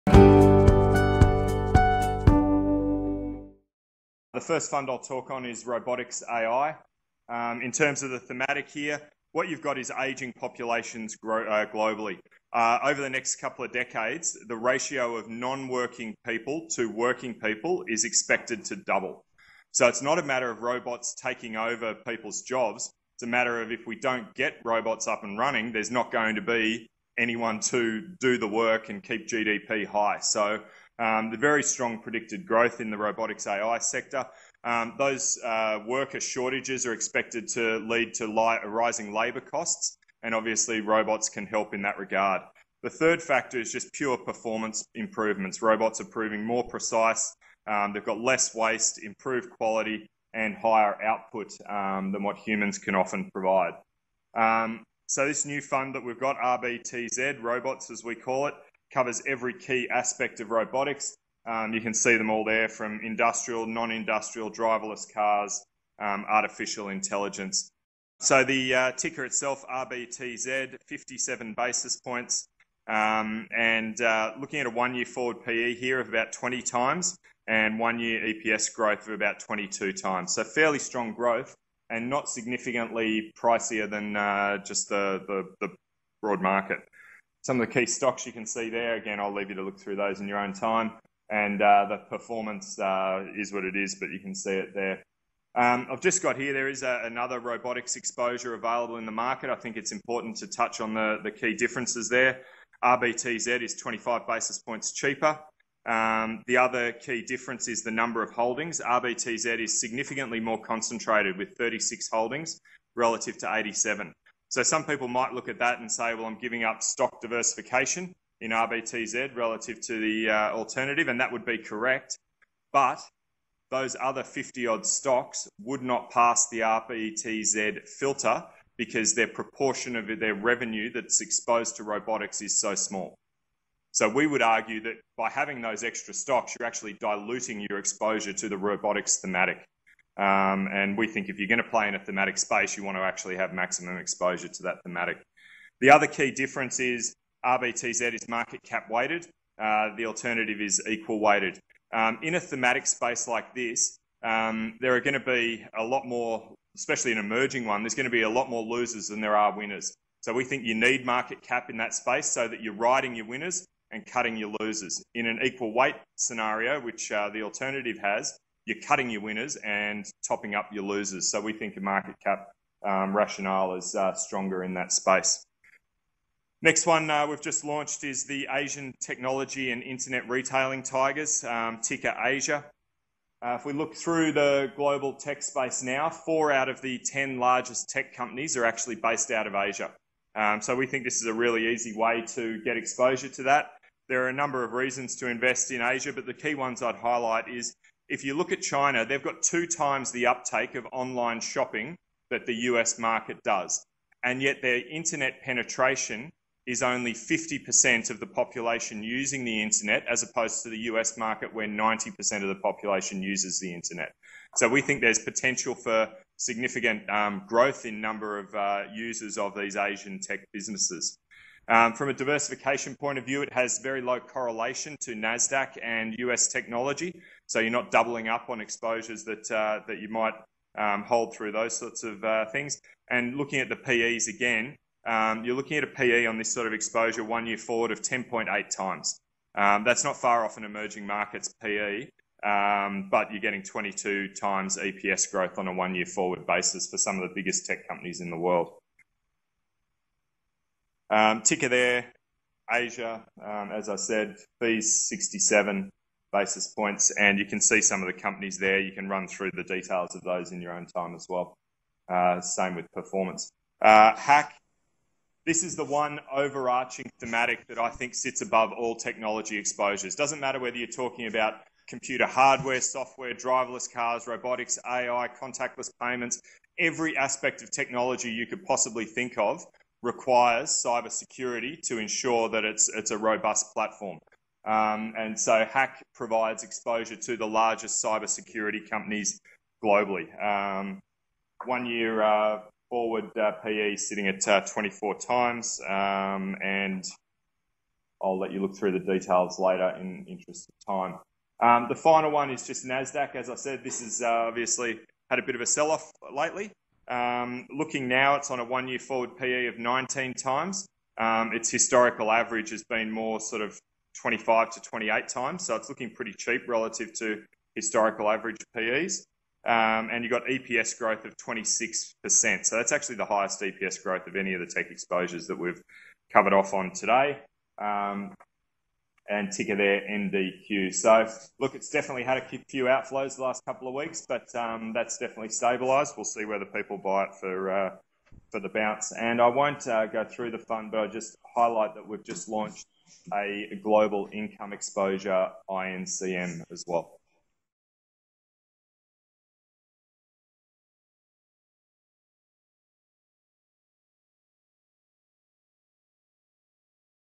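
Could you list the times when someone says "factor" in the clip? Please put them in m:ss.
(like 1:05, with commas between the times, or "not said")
0:43.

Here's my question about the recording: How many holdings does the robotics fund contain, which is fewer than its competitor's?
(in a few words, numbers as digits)
36.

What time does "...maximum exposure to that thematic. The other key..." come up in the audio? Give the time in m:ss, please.
2:23.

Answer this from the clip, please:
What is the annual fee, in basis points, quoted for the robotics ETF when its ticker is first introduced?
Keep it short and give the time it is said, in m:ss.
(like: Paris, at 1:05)
57 basis points, at 1:10.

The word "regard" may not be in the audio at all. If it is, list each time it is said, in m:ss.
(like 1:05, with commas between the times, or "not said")
0:41.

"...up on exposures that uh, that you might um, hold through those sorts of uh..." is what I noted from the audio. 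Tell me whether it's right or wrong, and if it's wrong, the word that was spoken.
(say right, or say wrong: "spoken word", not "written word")
right.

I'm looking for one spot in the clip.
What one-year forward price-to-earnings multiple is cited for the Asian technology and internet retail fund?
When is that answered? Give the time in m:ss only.
3:58.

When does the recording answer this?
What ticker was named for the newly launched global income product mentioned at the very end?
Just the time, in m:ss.
5:45.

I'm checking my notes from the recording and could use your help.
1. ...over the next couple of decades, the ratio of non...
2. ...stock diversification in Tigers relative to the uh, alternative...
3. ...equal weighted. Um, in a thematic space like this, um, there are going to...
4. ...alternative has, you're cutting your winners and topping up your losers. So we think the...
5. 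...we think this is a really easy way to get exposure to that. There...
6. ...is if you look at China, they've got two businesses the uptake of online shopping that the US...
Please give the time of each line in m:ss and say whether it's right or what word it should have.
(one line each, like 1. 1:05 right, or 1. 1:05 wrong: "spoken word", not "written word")
1. 0:12 right
2. 1:56 wrong: "RBTZ", not "Tigers"
3. 2:30 right
4. 2:47 right
5. 3:10 right
6. 3:17 wrong: "times", not "businesses".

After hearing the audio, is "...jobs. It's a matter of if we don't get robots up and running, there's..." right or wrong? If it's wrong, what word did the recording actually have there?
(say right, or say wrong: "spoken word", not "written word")
right.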